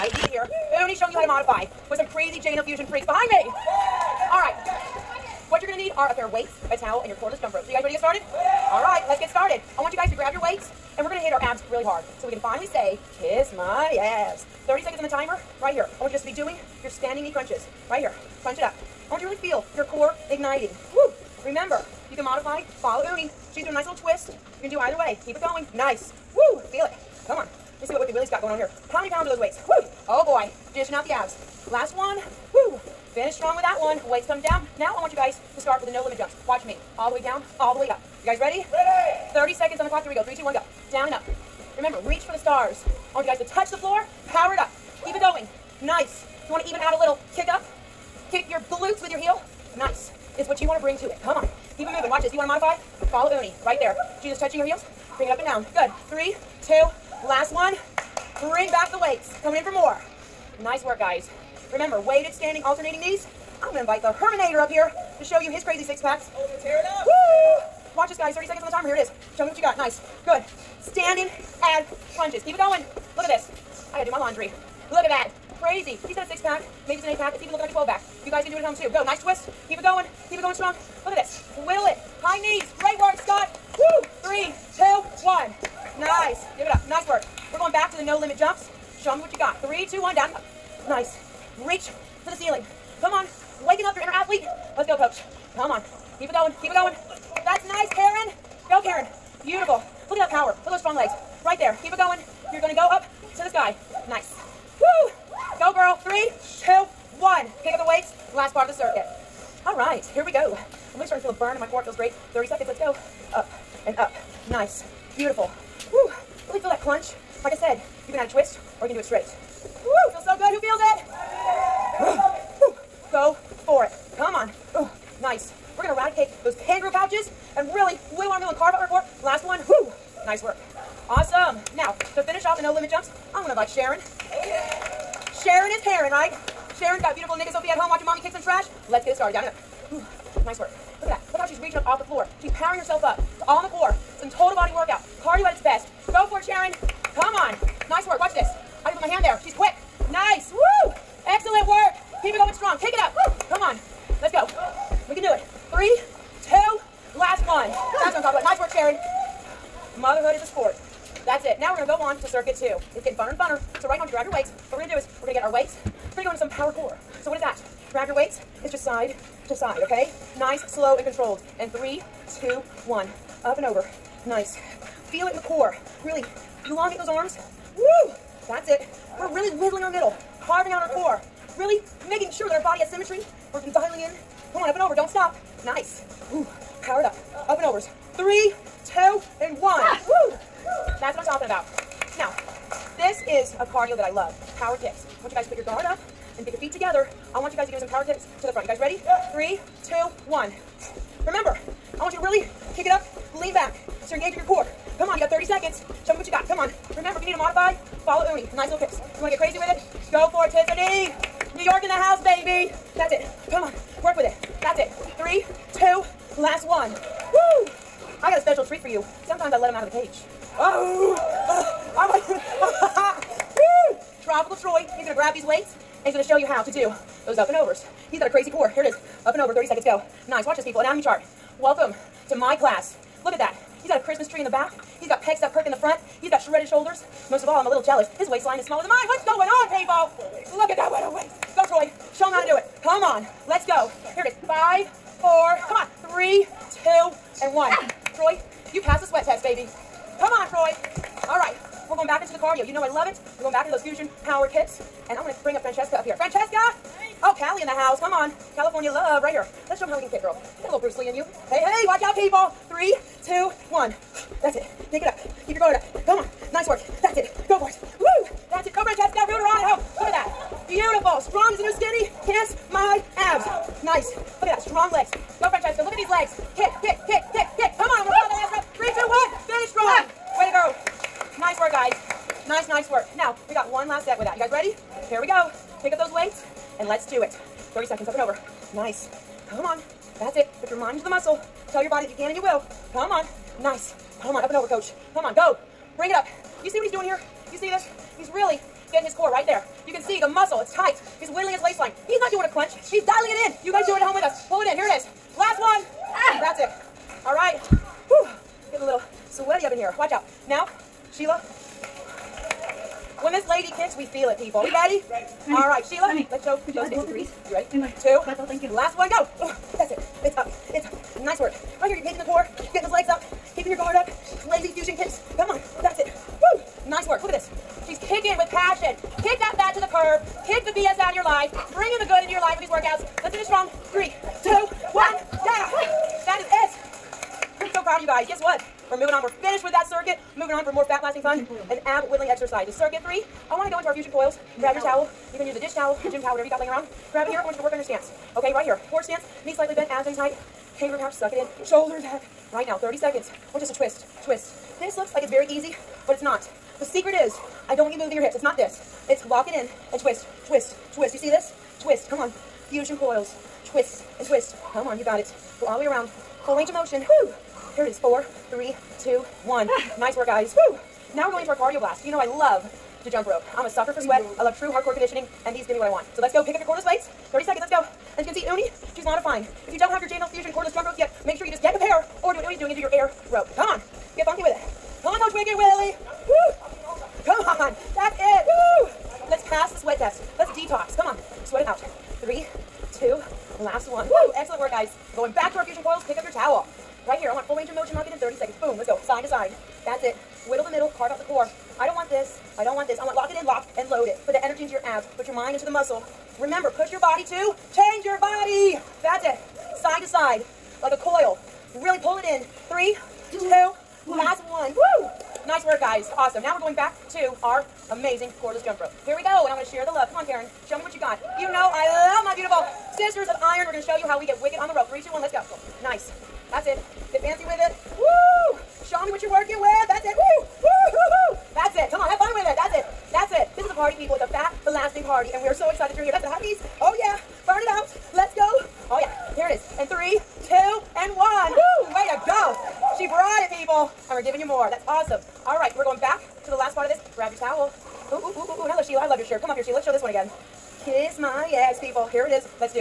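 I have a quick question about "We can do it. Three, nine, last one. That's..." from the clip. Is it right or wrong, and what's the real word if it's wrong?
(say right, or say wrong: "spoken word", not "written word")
wrong: "two", not "nine".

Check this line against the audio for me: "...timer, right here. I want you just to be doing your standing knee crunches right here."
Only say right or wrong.
right.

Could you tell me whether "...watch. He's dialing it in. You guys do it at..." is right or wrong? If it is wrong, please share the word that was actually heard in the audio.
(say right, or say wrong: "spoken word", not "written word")
wrong: "crunch", not "watch".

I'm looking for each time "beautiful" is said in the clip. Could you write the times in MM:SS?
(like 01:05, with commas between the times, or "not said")
01:39, 01:55, 02:17, 04:30, 07:02.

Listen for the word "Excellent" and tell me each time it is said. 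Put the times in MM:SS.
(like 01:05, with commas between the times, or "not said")
02:31, 06:34.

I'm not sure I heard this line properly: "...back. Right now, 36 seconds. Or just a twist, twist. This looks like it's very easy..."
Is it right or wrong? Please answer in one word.
wrong.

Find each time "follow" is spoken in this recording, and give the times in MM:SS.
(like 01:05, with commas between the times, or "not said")
00:22, 00:53, 03:28.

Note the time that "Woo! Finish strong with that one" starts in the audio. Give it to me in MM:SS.
00:32.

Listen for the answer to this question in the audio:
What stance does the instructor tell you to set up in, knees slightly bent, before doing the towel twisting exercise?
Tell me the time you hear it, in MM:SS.
05:48.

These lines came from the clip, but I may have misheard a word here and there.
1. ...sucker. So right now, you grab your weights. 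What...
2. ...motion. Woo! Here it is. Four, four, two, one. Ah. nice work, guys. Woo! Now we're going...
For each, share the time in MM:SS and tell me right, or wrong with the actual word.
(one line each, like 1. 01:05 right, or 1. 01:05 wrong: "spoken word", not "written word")
1. 02:43 wrong: "funner", not "sucker"
2. 06:06 wrong: "three", not "four".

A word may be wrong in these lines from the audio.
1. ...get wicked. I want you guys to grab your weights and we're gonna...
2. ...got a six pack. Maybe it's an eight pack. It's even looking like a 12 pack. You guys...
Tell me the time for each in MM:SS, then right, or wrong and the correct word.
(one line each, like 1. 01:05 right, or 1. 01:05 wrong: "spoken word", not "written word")
1. 00:09 wrong: "started", not "wicked"
2. 01:16 right.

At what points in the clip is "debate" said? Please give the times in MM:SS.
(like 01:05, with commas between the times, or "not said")
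not said.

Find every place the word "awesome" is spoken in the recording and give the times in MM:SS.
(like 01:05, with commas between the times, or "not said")
02:11, 06:56, 07:24.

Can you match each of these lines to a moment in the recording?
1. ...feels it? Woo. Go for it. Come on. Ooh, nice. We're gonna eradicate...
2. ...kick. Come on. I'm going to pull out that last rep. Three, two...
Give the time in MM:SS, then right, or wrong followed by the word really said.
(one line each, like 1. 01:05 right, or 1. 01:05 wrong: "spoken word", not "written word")
1. 02:00 right
2. 04:37 right.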